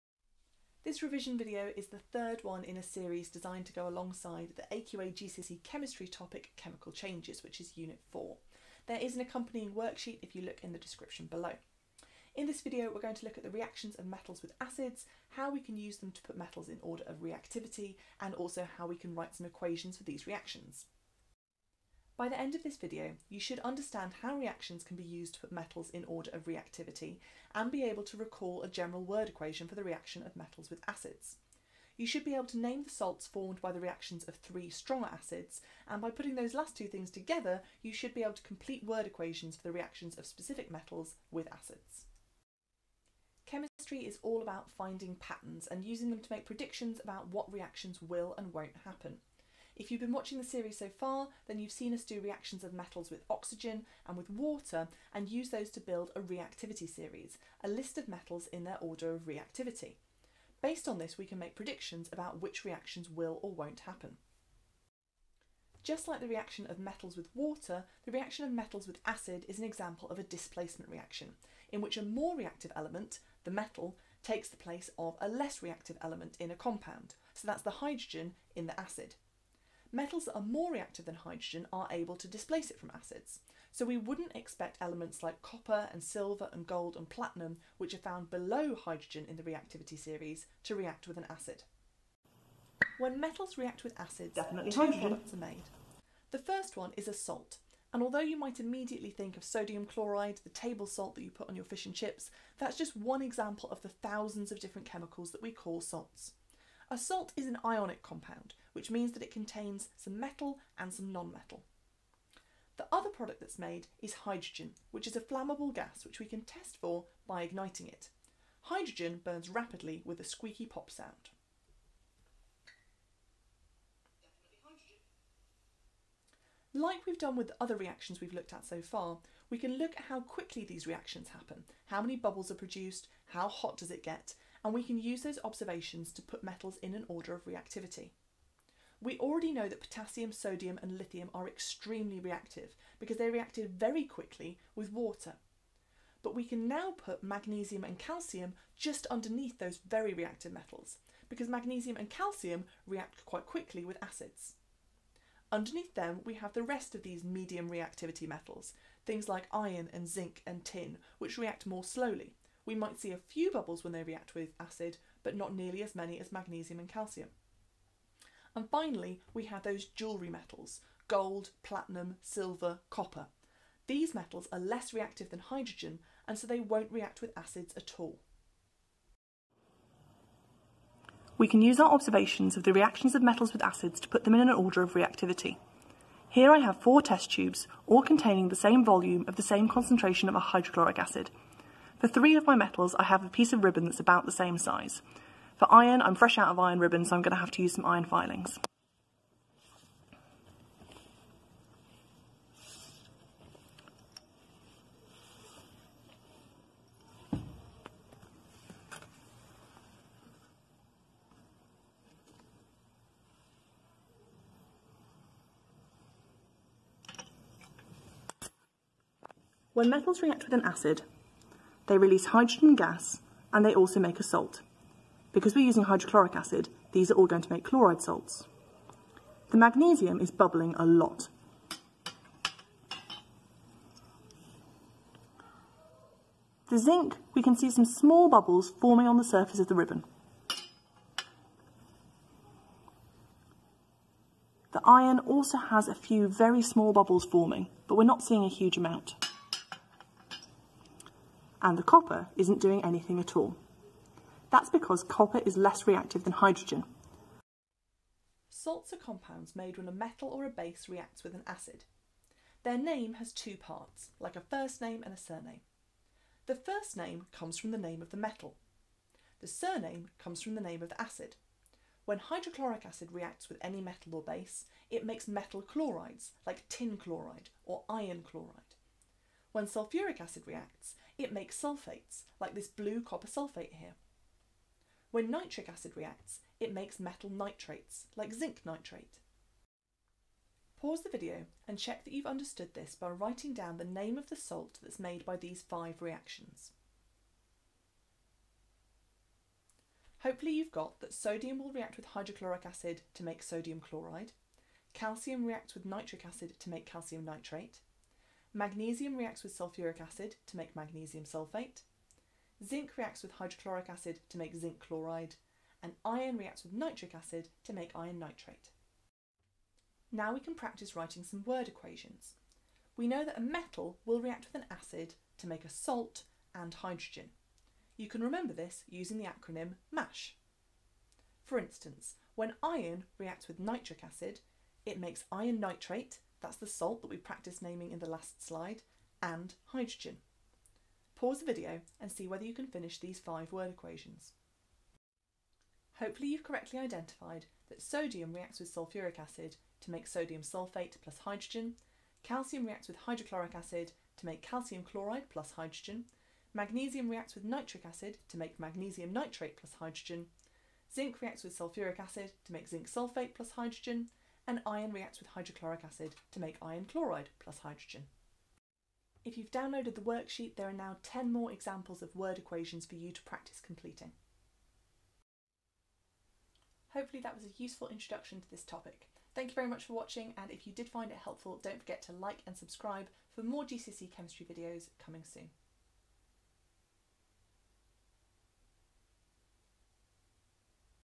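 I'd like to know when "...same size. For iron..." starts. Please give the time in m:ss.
3:14.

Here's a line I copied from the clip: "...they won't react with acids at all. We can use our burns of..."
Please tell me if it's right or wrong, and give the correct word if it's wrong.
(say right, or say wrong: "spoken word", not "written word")
wrong: "observations", not "burns".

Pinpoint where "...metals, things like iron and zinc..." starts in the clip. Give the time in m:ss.
2:38.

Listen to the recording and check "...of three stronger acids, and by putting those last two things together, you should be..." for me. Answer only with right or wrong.
right.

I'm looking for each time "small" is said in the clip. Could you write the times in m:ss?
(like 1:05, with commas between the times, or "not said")
3:57, 4:06.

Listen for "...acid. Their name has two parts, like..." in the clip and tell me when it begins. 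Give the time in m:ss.
4:21.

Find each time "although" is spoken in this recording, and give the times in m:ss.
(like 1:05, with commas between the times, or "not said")
1:38.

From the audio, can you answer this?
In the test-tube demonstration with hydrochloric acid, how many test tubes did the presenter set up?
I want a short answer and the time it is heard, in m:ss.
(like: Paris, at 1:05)
4, at 3:06.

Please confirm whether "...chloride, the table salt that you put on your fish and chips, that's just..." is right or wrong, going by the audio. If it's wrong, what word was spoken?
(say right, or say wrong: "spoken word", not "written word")
right.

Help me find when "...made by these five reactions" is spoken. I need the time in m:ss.
4:54.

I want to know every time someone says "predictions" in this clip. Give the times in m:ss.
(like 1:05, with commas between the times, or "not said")
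0:46, 1:01.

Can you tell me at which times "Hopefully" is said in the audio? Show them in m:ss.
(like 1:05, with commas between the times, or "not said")
5:00, 5:45, 6:16.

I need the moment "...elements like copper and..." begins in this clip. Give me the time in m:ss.
1:24.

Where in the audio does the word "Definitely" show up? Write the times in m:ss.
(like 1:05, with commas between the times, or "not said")
1:34.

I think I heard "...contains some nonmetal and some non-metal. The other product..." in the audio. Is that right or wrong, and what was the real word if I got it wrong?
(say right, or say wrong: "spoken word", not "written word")
wrong: "metal", not "nonmetal".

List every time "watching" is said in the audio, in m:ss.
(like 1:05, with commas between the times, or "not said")
0:50, 6:19.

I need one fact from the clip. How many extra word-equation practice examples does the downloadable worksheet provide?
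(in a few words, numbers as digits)
10.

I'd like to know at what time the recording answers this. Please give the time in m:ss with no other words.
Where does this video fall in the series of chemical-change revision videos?
0:01.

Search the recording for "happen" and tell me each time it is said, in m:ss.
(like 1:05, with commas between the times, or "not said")
0:48, 1:03, 2:11.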